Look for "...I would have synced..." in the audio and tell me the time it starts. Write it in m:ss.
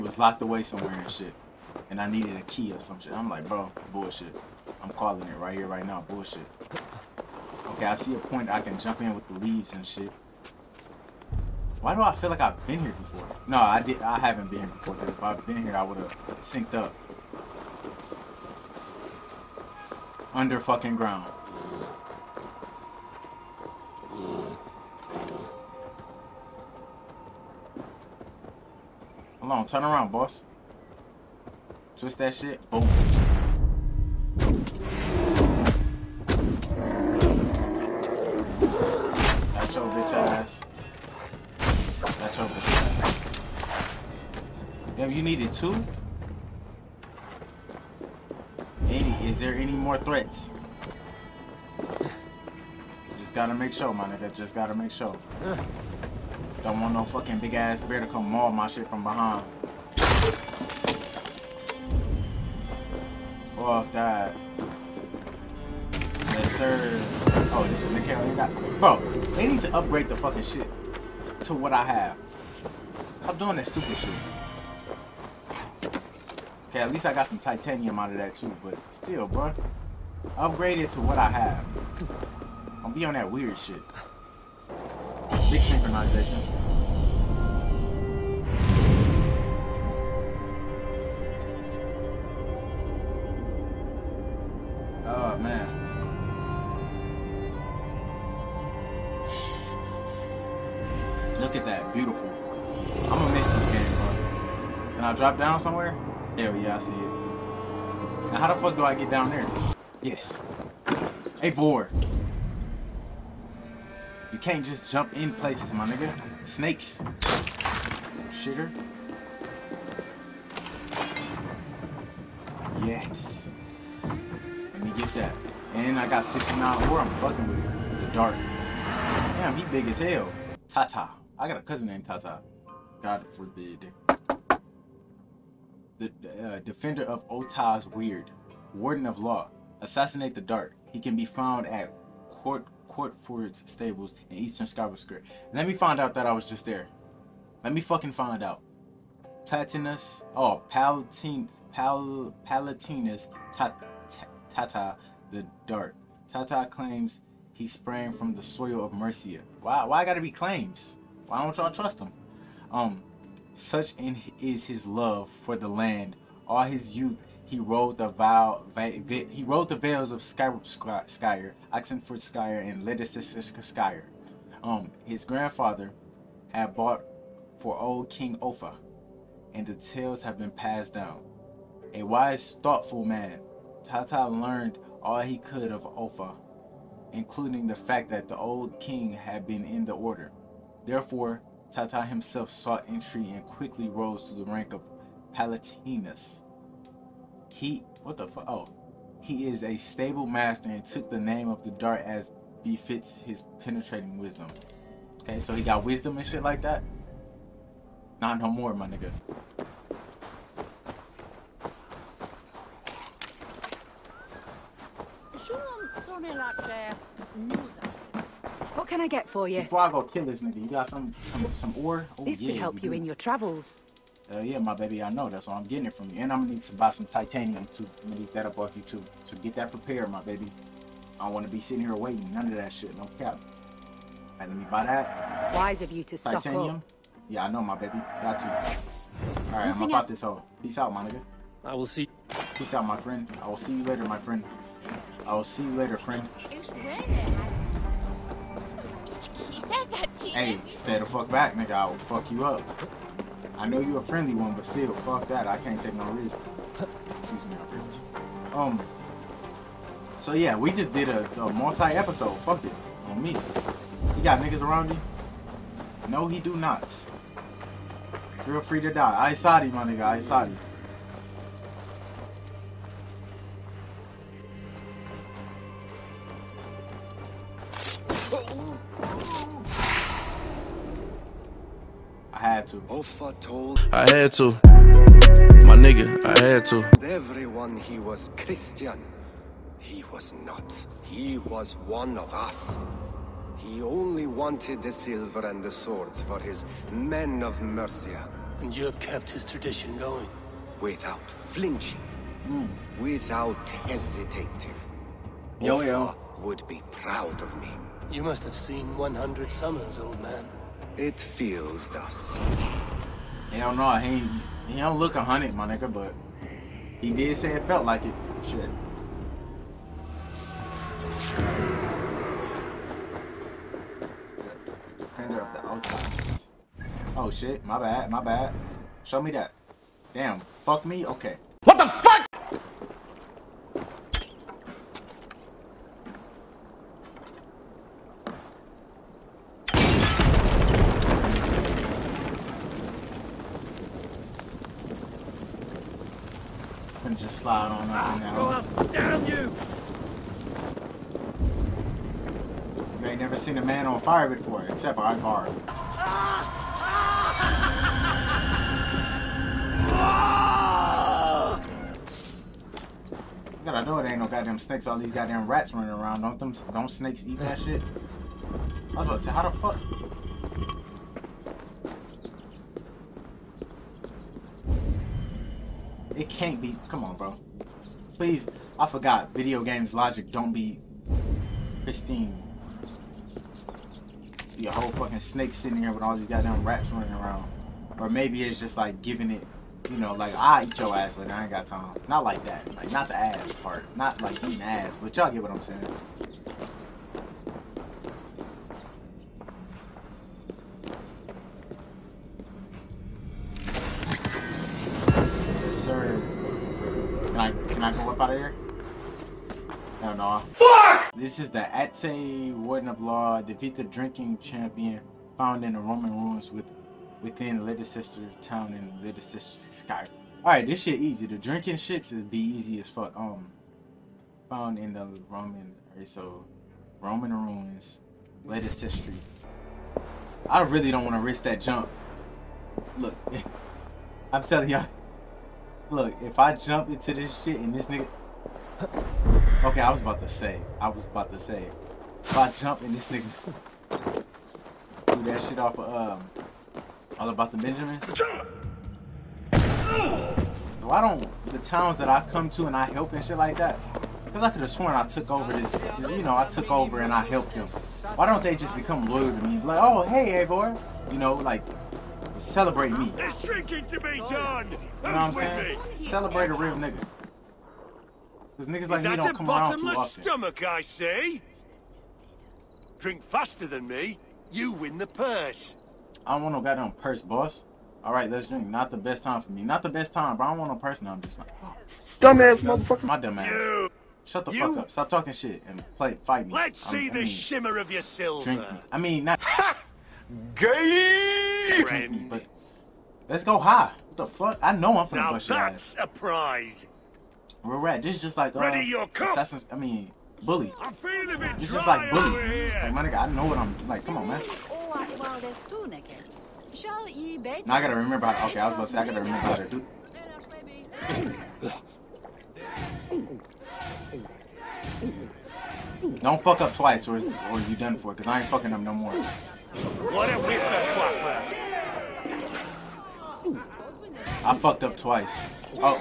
0:15.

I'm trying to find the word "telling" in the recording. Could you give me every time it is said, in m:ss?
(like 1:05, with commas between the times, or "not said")
7:14.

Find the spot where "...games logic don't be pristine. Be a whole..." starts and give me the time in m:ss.
6:19.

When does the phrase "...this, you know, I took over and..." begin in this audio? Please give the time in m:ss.
7:35.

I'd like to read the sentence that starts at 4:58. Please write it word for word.
And you have kept his tradition going?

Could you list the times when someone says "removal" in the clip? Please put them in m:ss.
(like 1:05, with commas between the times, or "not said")
not said.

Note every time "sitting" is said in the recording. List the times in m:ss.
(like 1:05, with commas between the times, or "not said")
3:51, 6:25.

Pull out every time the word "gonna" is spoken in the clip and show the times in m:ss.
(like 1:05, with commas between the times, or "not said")
1:43, 3:46.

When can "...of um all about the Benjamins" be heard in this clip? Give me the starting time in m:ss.
7:25.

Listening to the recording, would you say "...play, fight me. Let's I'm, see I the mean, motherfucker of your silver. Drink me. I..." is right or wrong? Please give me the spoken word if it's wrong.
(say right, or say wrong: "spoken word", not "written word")
wrong: "shimmer", not "motherfucker".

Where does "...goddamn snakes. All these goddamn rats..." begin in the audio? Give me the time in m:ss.
6:04.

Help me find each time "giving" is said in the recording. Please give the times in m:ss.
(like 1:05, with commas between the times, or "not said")
6:29.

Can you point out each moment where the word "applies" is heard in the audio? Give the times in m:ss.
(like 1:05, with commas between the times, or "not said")
not said.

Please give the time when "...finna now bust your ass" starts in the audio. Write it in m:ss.
8:15.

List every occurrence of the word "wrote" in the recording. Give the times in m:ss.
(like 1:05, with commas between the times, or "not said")
2:47.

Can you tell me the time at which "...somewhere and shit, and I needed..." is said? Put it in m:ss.
0:00.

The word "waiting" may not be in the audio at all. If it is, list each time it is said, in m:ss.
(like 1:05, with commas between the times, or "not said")
3:51.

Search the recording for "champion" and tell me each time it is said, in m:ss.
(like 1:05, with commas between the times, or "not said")
6:54.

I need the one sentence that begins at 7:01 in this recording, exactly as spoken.
The drinking shits is be easy as fuck.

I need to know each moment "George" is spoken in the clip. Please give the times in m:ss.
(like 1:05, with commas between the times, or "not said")
not said.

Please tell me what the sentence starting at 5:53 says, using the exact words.
You ain't never seen a man on fire before, except on bar.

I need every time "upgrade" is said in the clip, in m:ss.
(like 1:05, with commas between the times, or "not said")
1:09, 1:20.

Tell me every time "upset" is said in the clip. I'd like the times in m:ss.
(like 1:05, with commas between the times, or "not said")
not said.